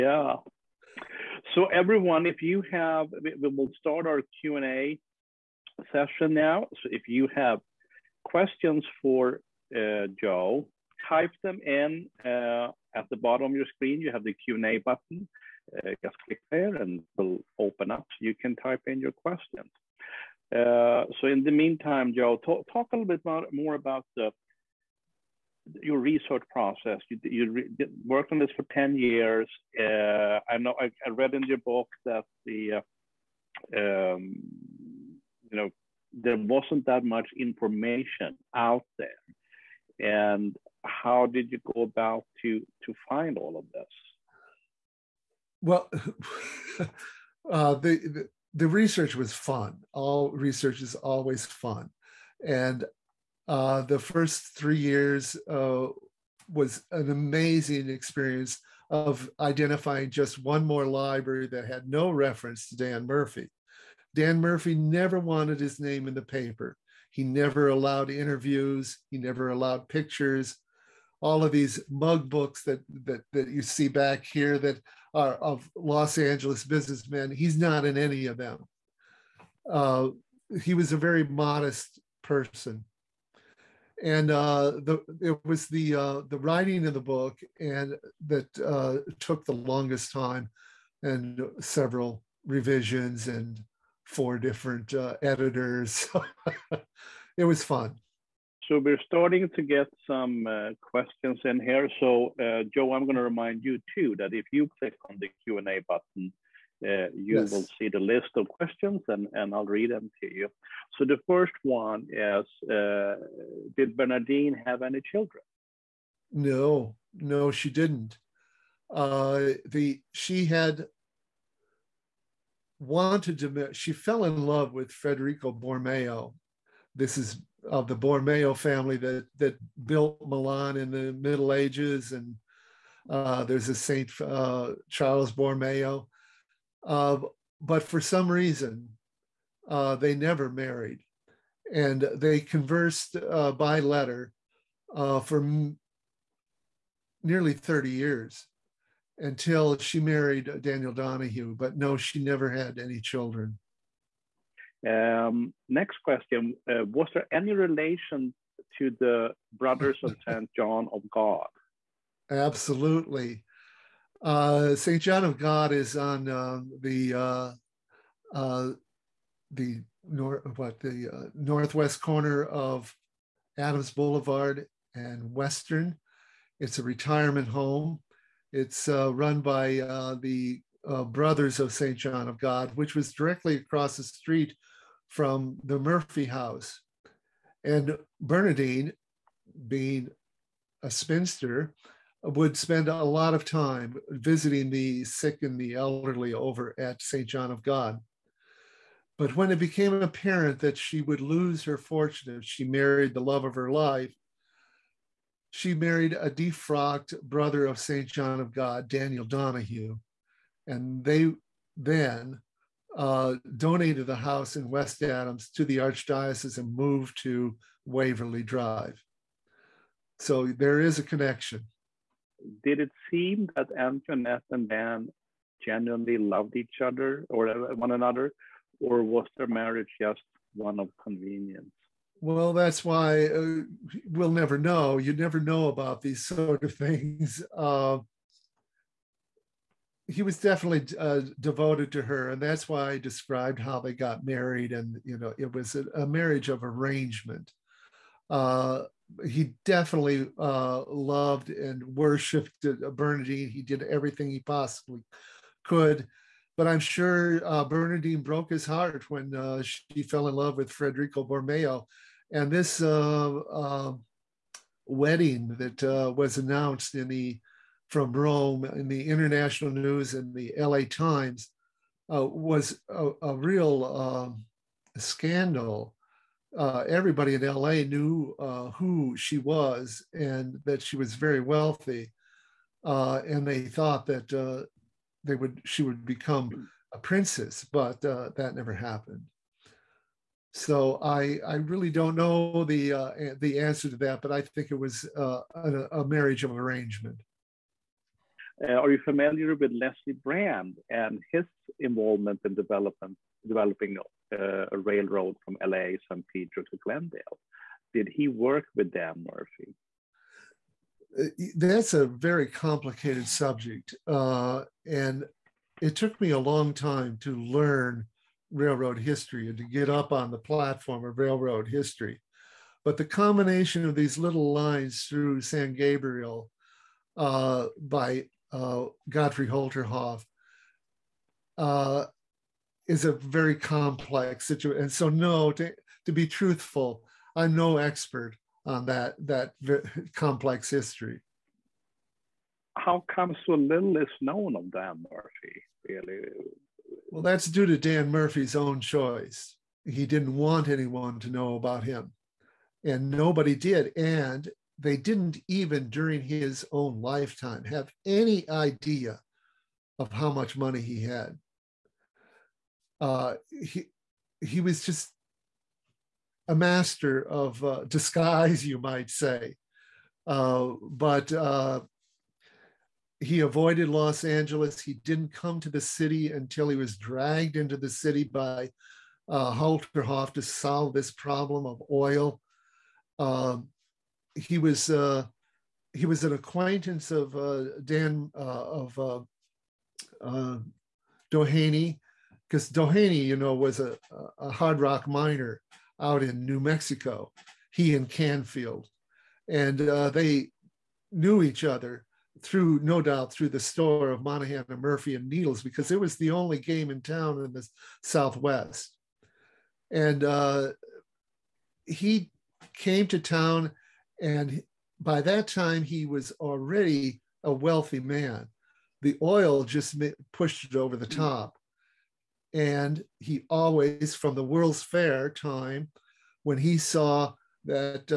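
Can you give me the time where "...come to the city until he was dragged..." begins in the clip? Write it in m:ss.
6:15.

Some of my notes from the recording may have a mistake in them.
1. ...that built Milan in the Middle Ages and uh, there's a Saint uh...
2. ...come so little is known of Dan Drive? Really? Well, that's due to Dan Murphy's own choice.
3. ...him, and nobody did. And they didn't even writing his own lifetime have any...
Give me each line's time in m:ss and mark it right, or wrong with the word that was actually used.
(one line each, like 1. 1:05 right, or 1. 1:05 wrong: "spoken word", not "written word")
1. 2:09 right
2. 5:43 wrong: "Murphy", not "Drive"
3. 5:51 wrong: "during", not "writing".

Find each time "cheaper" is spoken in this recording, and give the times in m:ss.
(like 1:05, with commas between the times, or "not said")
not said.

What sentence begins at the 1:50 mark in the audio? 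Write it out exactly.
So the first one is, uh, did Bernadine have any children?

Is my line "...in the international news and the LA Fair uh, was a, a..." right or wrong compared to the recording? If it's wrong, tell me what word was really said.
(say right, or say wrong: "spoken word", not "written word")
wrong: "Times", not "Fair".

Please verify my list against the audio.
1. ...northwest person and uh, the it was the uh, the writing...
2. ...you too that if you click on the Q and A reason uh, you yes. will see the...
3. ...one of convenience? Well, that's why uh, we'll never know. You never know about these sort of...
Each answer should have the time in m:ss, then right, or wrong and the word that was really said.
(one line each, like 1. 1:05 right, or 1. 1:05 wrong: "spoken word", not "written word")
1. 1:21 wrong: "modest", not "northwest"
2. 1:43 wrong: "button", not "reason"
3. 3:50 right.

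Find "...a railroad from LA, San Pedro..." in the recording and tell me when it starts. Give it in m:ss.
5:04.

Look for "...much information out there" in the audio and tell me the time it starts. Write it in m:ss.
0:37.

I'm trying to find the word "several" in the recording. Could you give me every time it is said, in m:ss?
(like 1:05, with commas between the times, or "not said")
1:31.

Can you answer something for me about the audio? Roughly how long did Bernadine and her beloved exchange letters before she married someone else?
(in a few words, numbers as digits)
30 years.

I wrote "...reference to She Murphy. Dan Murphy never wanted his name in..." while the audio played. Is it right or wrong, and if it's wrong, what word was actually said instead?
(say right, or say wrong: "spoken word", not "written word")
wrong: "Dan", not "She".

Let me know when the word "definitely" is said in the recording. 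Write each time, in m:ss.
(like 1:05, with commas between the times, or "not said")
4:00, 4:09.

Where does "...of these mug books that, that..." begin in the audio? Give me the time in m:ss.
1:11.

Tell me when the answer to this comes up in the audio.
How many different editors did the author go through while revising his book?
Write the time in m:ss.
1:34.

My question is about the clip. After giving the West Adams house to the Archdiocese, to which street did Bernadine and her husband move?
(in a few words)
Waverly Drive.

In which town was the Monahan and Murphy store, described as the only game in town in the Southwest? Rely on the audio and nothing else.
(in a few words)
Needles.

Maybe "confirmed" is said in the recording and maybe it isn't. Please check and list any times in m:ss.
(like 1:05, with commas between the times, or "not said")
not said.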